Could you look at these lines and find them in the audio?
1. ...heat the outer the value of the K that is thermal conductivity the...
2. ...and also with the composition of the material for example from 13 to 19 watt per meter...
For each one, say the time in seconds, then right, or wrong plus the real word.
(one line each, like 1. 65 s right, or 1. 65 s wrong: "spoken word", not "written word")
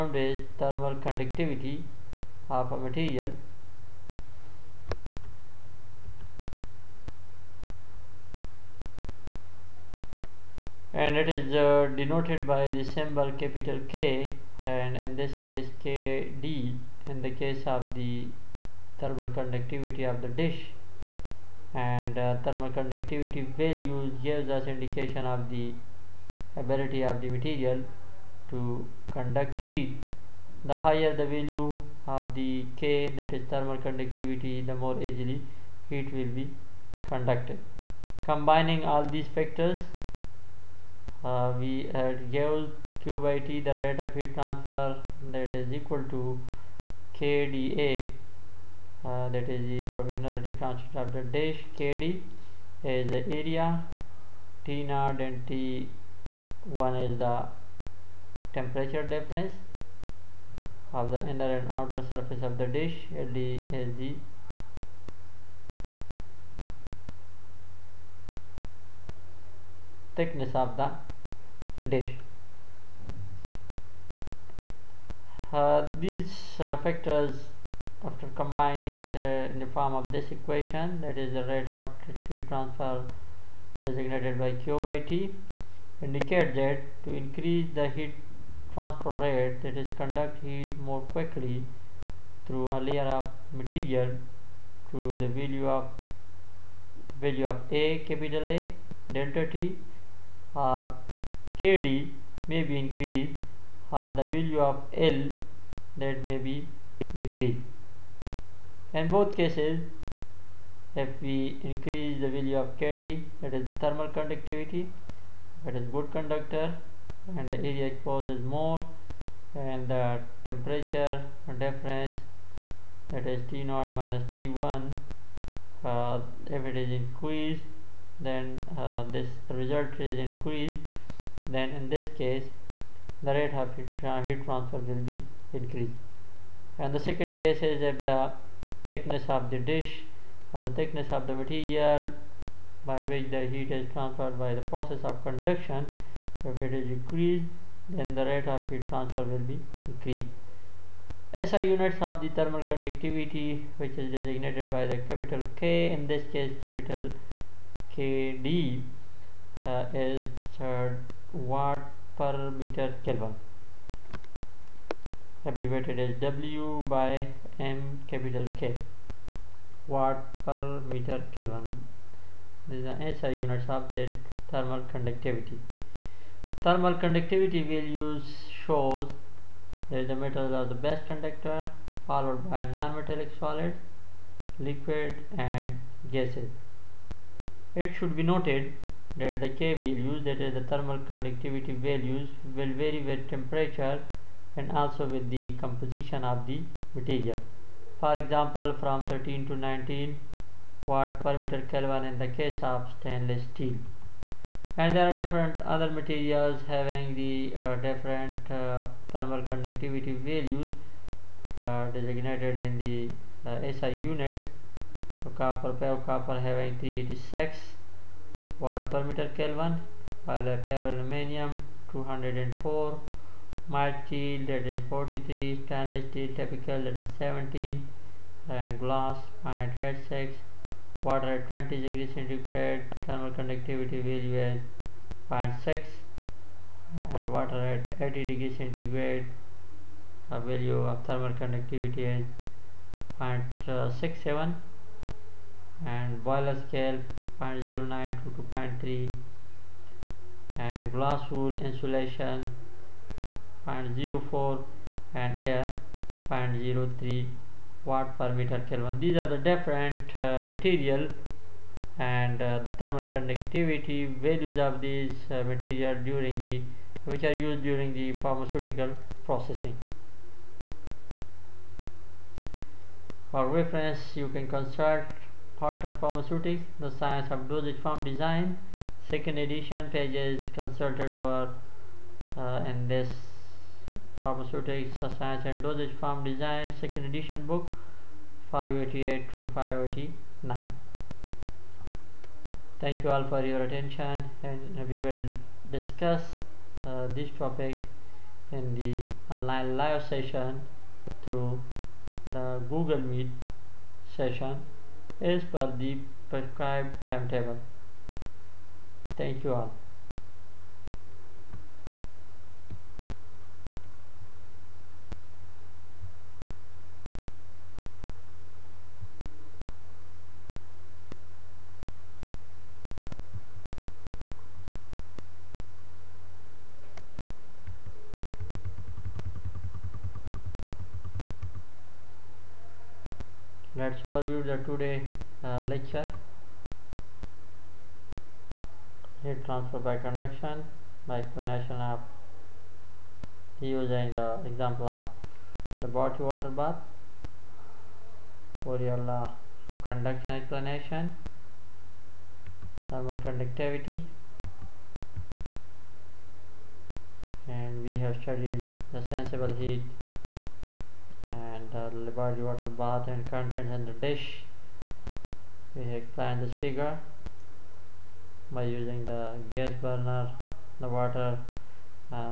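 1. 29 s wrong: "higher", not "outer"
2. 194 s right.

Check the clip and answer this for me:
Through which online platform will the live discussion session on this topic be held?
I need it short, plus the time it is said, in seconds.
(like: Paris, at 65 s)
Google Meet, at 302 s.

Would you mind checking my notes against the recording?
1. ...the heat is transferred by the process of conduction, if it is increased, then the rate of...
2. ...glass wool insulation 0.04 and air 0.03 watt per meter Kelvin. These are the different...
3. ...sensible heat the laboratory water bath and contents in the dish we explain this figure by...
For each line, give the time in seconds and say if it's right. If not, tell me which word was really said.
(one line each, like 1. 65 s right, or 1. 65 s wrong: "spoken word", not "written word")
1. 143 s right
2. 250 s right
3. 359 s right.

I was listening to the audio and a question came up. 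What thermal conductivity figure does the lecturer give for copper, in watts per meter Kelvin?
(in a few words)
386.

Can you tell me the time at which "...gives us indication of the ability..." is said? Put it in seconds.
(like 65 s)
24 s.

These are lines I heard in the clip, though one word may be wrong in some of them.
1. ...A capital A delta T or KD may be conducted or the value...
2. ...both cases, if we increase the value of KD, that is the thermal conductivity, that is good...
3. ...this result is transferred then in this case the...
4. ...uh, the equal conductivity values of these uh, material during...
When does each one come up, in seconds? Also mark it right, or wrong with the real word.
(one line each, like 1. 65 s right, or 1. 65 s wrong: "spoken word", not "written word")
1. 97 s wrong: "increased", not "conducted"
2. 109 s right
3. 129 s wrong: "increased", not "transferred"
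4. 262 s wrong: "thermal", not "equal".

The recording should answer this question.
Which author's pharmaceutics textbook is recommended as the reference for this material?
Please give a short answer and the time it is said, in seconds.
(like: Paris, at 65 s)
Aulton, at 275 s.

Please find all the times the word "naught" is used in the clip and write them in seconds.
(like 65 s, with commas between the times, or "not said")
54 s, 123 s.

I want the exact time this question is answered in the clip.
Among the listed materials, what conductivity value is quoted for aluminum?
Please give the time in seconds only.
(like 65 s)
221 s.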